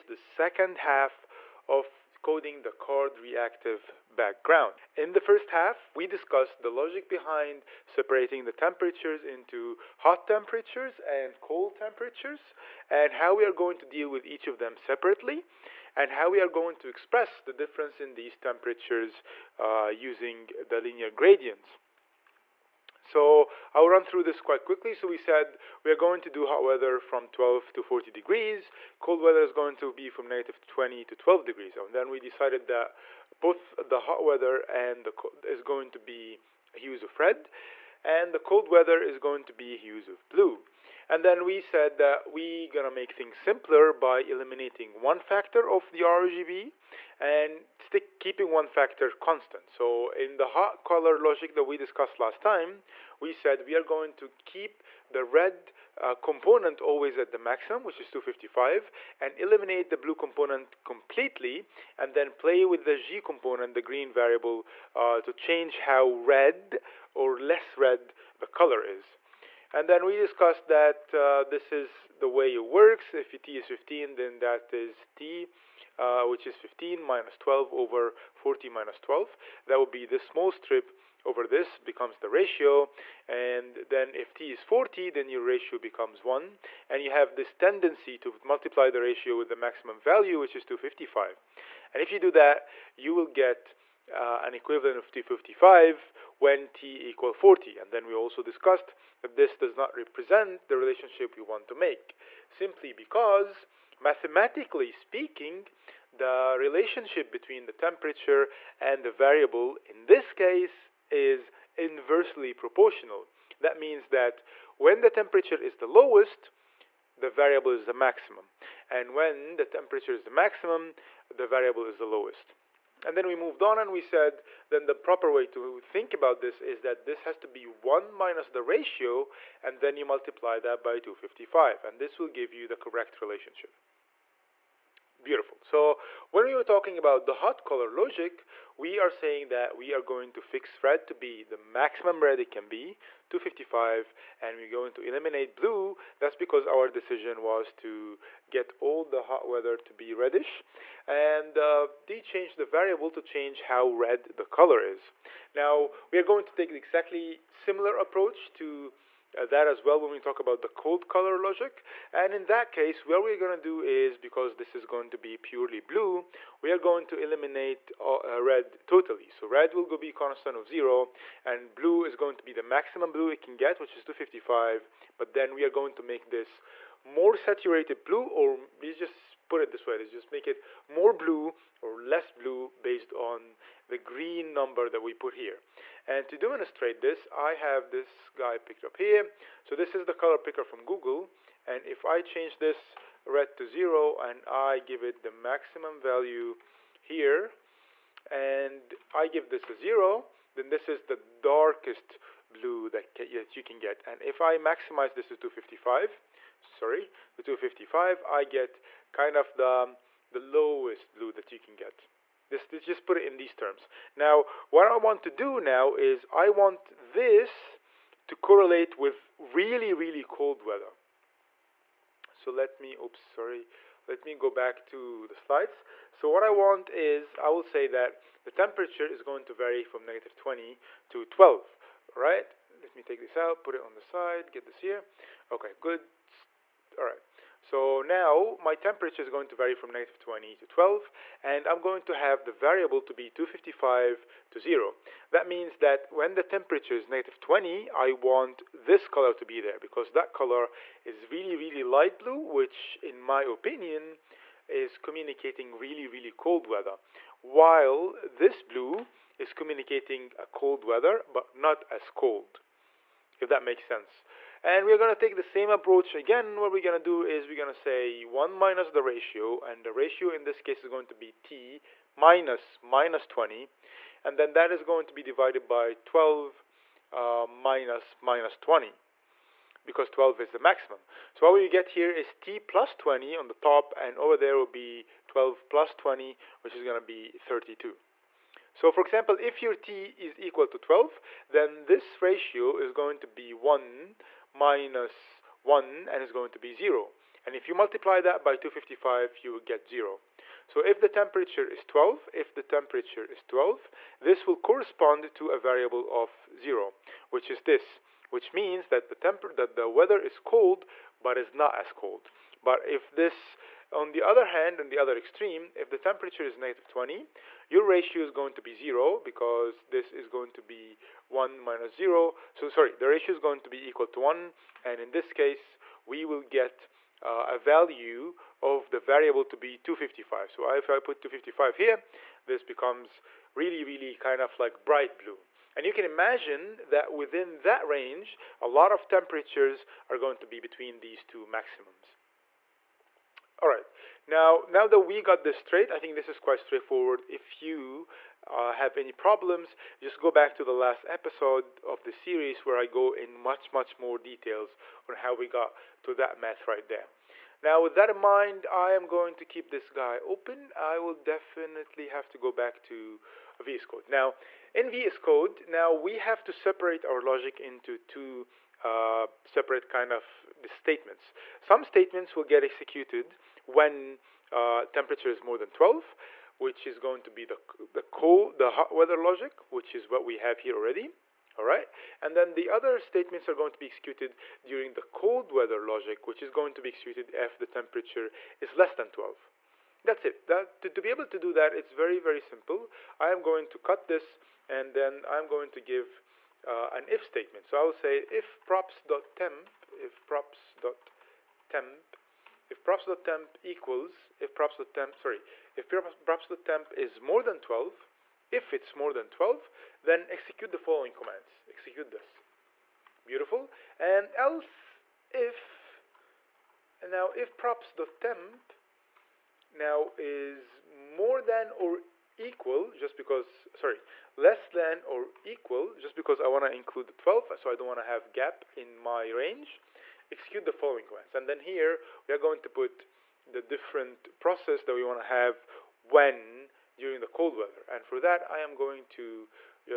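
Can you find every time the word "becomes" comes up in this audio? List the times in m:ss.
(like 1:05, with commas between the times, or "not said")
1:21, 1:25, 5:32.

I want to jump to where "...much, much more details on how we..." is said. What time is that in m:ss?
5:53.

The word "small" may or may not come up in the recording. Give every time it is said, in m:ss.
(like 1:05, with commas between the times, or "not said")
1:20.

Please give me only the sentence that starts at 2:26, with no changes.
That's because our decision was to get all the hot weather to be reddish.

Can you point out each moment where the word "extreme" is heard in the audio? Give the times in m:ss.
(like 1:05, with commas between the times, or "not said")
5:15.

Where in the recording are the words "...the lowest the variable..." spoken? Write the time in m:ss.
1:55.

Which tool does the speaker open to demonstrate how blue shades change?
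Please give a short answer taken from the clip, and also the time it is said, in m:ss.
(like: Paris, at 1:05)
color picker from Google, at 3:10.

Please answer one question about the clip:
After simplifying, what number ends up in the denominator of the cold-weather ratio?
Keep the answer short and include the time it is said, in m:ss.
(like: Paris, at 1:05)
32, at 4:47.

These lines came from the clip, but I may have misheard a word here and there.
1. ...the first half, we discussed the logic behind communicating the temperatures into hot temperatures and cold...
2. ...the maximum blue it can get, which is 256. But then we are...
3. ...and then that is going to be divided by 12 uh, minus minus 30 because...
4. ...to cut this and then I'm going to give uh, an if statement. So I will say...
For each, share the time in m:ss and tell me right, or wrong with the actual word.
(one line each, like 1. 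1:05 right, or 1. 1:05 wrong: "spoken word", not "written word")
1. 0:05 wrong: "separating", not "communicating"
2. 2:52 wrong: "255", not "256"
3. 4:34 wrong: "20", not "30"
4. 6:33 right.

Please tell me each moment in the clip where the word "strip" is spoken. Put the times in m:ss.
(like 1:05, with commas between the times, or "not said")
1:20.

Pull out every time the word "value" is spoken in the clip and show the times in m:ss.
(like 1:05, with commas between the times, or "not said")
1:29, 3:16, 5:27.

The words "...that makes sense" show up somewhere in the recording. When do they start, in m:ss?
4:23.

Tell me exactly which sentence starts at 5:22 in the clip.
So sorry, the ratio is going to be equal to one.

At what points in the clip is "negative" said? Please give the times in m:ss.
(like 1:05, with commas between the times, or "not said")
0:30, 3:50, 3:59, 4:07, 5:16.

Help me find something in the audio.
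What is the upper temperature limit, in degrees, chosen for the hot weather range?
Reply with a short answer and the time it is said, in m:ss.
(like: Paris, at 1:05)
40, at 0:27.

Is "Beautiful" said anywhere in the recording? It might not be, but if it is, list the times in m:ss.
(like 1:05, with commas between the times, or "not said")
2:15, 6:53.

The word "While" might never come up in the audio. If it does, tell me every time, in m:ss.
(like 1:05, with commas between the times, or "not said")
4:17.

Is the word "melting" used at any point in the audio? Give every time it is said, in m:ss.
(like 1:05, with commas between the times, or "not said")
not said.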